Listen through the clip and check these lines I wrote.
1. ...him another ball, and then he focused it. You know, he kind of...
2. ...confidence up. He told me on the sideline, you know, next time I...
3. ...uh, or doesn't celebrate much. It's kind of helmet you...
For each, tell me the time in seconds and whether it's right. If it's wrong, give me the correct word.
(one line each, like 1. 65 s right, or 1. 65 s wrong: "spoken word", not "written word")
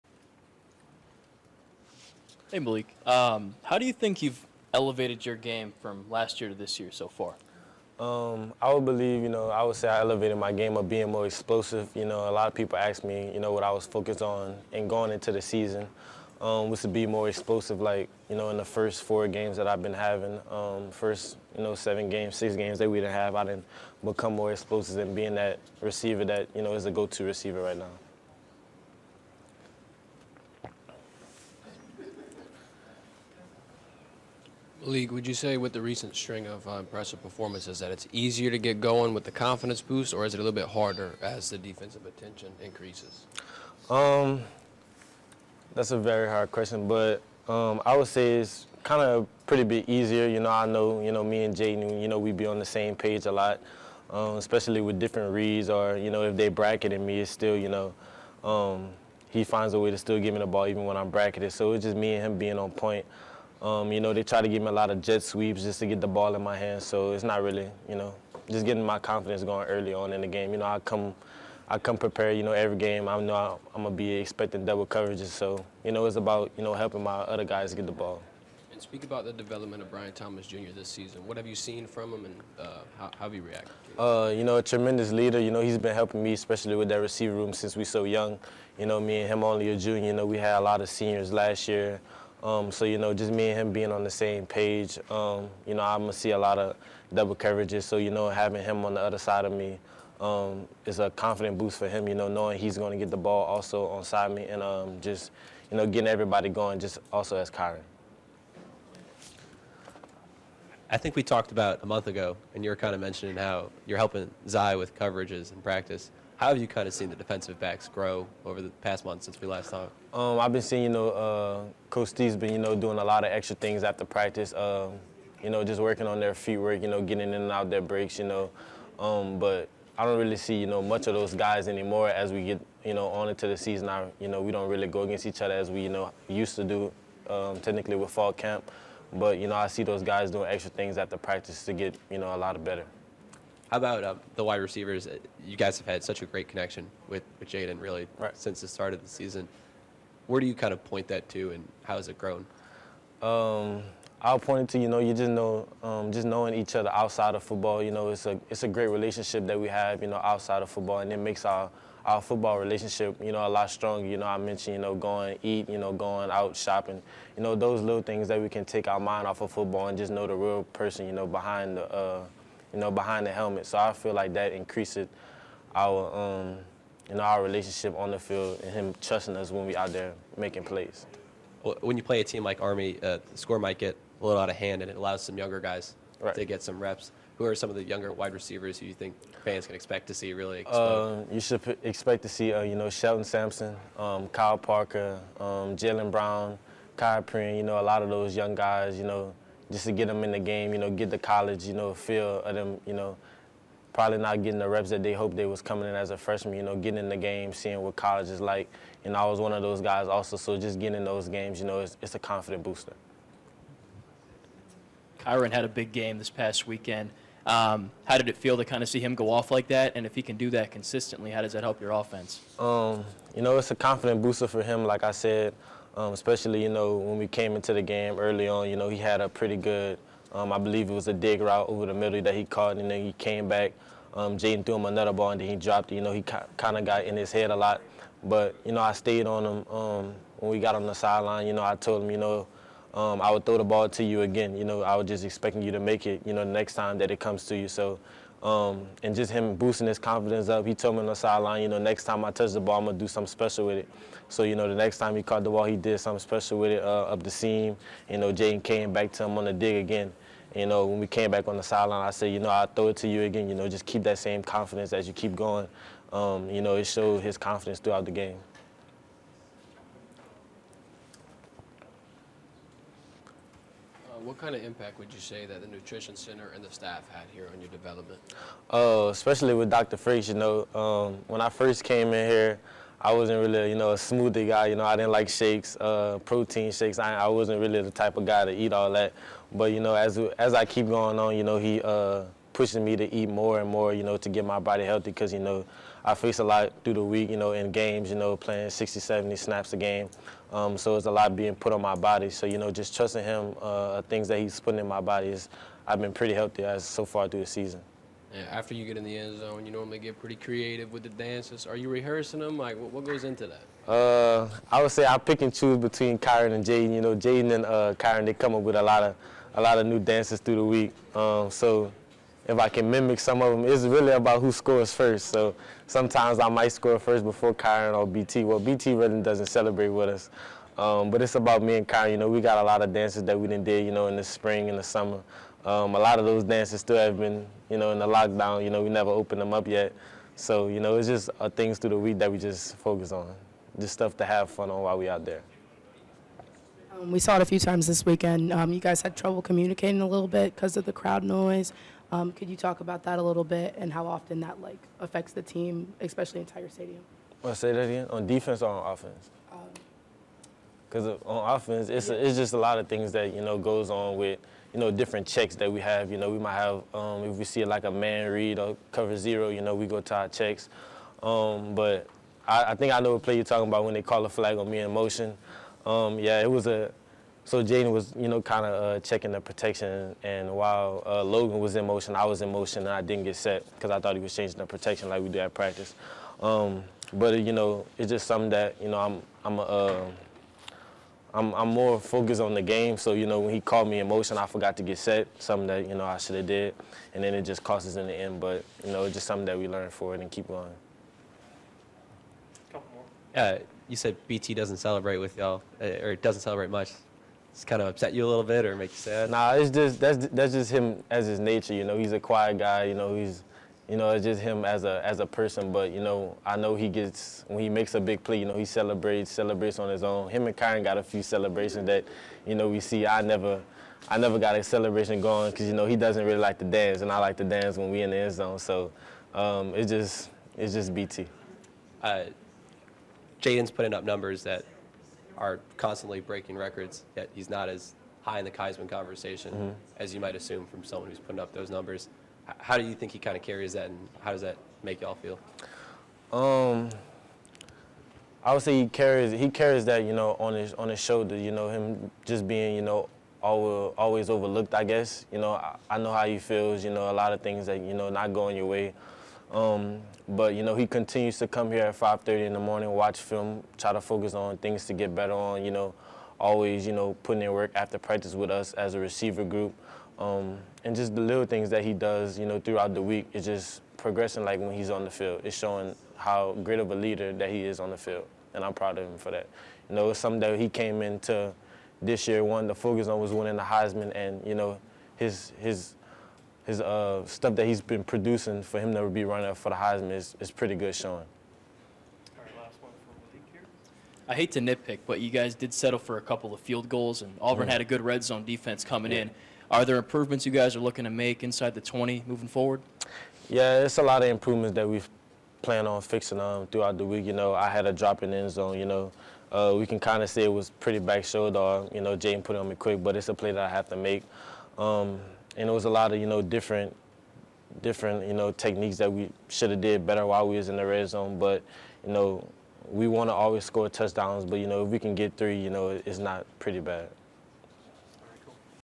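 1. 234 s wrong: "dropped", not "focused"
2. 249 s right
3. 405 s wrong: "upset", not "helmet".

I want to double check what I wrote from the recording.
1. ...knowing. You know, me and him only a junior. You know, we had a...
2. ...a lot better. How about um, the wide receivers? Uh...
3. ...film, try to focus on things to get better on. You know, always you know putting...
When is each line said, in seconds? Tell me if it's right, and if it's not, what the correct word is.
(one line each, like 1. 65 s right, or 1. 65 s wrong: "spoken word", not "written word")
1. 88 s wrong: "young", not "knowing"
2. 142 s right
3. 463 s right.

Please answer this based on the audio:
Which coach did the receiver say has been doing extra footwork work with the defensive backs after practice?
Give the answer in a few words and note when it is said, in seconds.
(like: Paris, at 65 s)
Coach Steve, at 121 s.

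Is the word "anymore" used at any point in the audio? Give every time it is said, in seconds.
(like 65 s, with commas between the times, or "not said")
131 s.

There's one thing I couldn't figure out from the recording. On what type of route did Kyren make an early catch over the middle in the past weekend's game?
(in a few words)
Dig route.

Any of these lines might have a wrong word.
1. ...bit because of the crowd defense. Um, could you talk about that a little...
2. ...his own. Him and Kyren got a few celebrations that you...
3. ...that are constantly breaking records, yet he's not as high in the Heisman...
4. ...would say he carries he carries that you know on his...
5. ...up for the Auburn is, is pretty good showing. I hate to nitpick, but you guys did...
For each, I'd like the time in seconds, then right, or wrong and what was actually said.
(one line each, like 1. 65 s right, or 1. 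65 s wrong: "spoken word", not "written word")
1. 350 s wrong: "noise", not "defense"
2. 419 s right
3. 434 s right
4. 448 s right
5. 489 s wrong: "Heisman", not "Auburn".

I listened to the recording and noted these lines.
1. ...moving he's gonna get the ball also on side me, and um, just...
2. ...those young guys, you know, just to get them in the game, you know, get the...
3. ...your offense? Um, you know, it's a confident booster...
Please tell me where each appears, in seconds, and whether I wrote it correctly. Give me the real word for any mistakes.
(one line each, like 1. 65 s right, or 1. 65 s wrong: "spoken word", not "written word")
1. 102 s wrong: "knowing", not "moving"
2. 198 s right
3. 221 s right.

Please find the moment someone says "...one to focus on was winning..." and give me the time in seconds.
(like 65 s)
482 s.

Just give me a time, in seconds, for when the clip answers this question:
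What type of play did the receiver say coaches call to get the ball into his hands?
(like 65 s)
65 s.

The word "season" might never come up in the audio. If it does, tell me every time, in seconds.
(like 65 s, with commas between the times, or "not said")
15 s, 80 s, 133 s, 149 s, 307 s.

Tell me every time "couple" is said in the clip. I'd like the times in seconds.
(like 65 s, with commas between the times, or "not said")
402 s, 496 s.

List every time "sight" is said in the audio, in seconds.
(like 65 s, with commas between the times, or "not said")
not said.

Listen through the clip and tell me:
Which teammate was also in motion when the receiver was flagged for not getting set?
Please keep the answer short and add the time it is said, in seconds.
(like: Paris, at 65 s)
Logan, at 381 s.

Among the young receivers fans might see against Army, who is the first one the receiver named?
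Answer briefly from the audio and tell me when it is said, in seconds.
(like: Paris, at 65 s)
Shelton Sampson, at 192 s.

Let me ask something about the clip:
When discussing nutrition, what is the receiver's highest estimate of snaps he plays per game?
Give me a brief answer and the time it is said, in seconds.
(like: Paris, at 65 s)
70, at 298 s.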